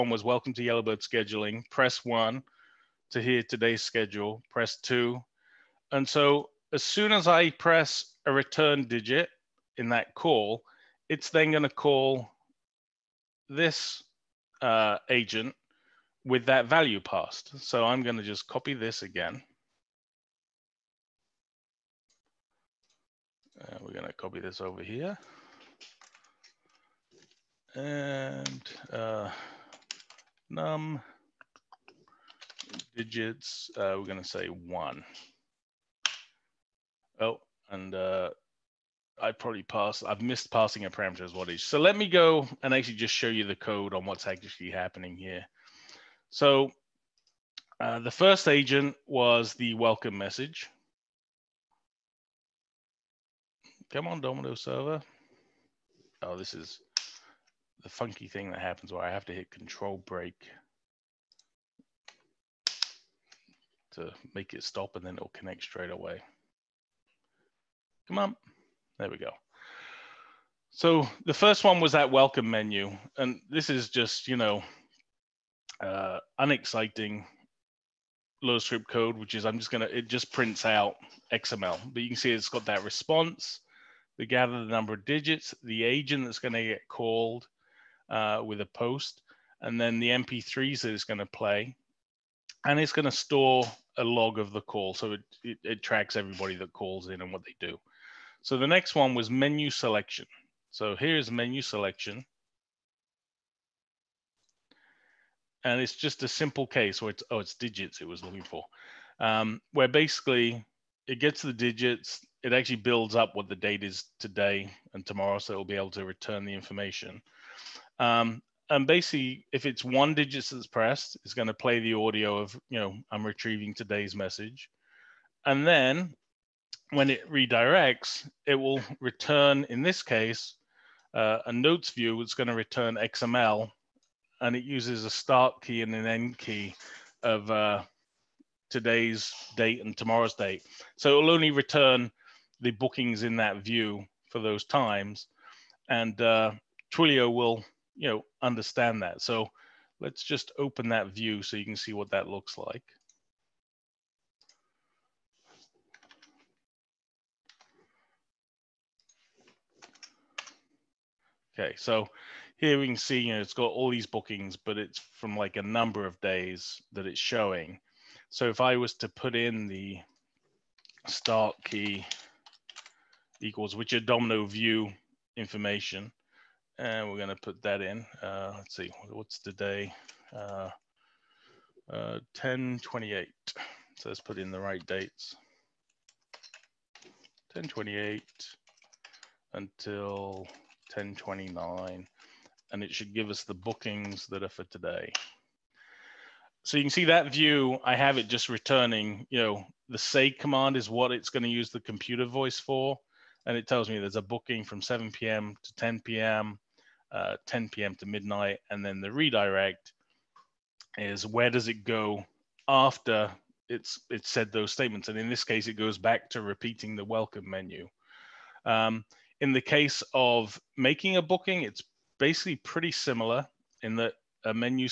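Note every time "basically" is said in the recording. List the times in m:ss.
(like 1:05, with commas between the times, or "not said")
1:49, 1:58, 3:42.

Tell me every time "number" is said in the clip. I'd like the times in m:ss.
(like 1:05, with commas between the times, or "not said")
1:24, 2:45.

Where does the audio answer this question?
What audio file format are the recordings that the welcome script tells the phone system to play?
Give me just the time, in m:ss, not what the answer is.
1:30.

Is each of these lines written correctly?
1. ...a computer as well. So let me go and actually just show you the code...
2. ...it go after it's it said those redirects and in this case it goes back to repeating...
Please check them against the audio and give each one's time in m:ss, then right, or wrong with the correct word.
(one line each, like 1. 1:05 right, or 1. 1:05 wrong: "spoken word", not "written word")
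1. 0:40 wrong: "parameter", not "computer"
2. 3:31 wrong: "statements", not "redirects".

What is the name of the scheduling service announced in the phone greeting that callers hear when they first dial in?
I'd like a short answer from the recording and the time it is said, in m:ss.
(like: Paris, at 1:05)
Yellowbird, at 0:00.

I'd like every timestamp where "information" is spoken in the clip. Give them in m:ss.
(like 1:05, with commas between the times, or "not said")
1:56, 2:55.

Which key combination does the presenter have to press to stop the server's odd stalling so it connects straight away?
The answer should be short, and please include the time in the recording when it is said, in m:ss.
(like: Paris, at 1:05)
Control break, at 0:59.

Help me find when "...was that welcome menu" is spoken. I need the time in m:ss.
1:11.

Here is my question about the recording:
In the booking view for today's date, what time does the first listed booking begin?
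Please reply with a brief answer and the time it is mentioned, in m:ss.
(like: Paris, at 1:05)
7 p.m., at 3:24.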